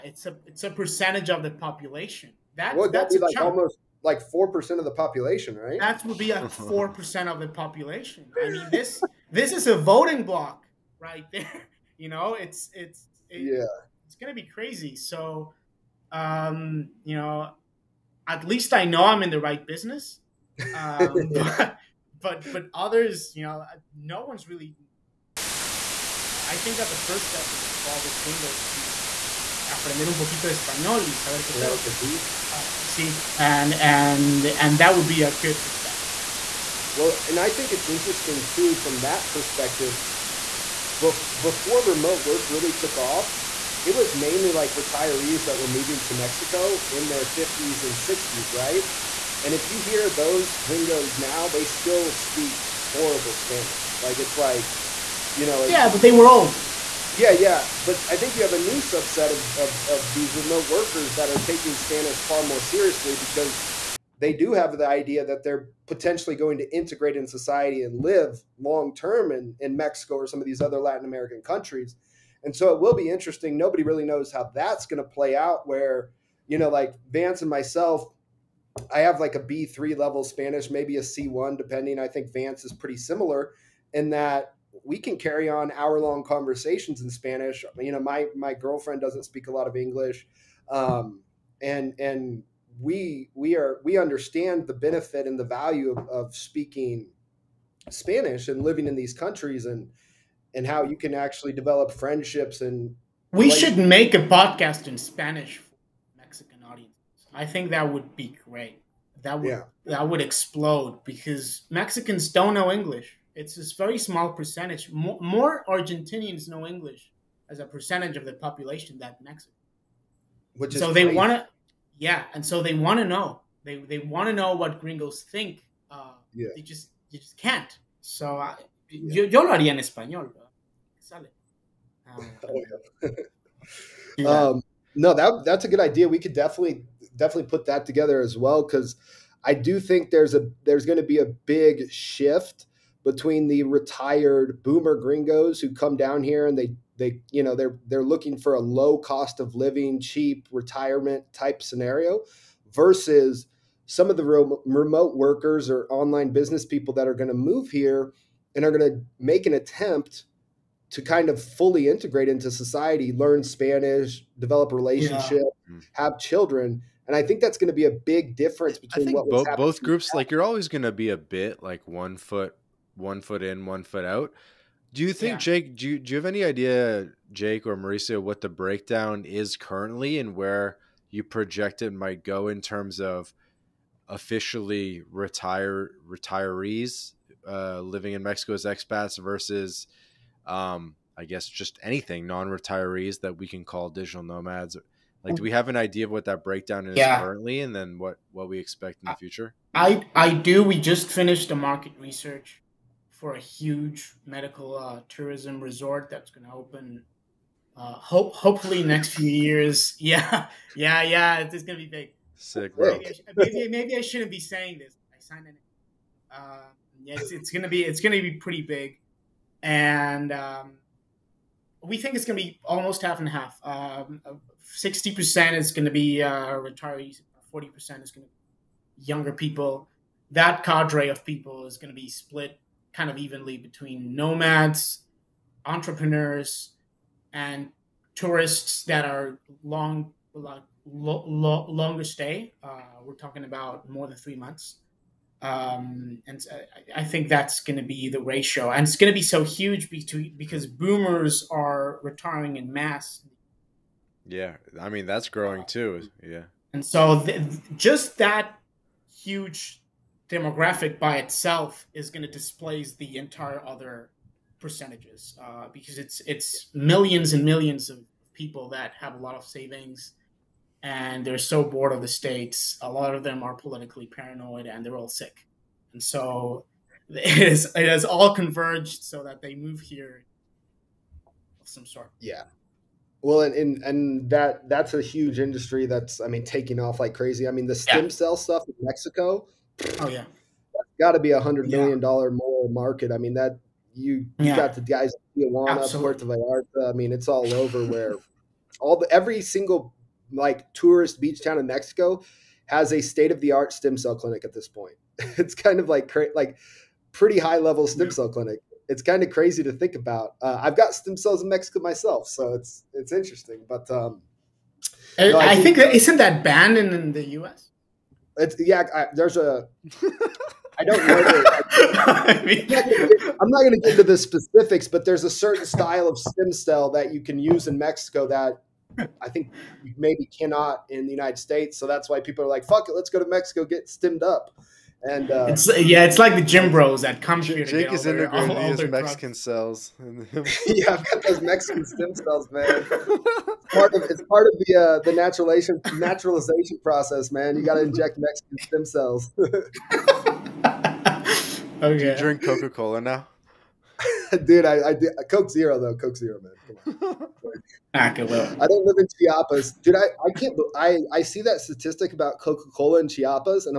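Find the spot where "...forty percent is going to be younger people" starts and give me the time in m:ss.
3:47.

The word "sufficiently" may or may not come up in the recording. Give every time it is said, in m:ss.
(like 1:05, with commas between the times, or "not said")
not said.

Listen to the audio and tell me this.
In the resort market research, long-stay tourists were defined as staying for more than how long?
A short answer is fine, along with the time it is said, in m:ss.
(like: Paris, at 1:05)
3 months, at 4:04.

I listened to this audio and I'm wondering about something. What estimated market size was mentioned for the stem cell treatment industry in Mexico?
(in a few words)
$100 million.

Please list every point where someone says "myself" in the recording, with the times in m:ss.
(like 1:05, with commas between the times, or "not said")
1:17, 5:11.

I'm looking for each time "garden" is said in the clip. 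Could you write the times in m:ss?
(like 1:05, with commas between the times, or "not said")
not said.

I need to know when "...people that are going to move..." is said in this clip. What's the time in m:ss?
2:36.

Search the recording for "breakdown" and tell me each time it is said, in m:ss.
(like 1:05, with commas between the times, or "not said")
2:58, 3:16.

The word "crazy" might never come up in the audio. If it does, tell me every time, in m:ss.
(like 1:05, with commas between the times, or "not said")
0:14, 4:47, 5:09.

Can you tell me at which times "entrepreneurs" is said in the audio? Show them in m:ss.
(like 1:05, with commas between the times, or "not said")
3:55.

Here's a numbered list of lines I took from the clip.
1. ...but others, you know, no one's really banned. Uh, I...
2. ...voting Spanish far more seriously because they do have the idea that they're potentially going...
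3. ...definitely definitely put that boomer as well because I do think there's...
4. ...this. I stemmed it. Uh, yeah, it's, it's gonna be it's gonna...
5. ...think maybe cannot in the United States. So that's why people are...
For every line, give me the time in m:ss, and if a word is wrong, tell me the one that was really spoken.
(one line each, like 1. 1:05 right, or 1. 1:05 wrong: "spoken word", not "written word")
1. 0:22 wrong: "happened", not "banned"
2. 1:01 wrong: "taking", not "voting"
3. 2:16 wrong: "together", not "boomer"
4. 3:34 wrong: "signed", not "stemmed"
5. 5:29 right.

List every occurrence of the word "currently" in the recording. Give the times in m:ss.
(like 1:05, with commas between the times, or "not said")
2:59, 3:17.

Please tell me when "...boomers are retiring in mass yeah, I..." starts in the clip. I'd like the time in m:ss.
4:10.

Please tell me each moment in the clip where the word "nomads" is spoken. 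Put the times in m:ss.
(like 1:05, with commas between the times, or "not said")
3:14, 3:54.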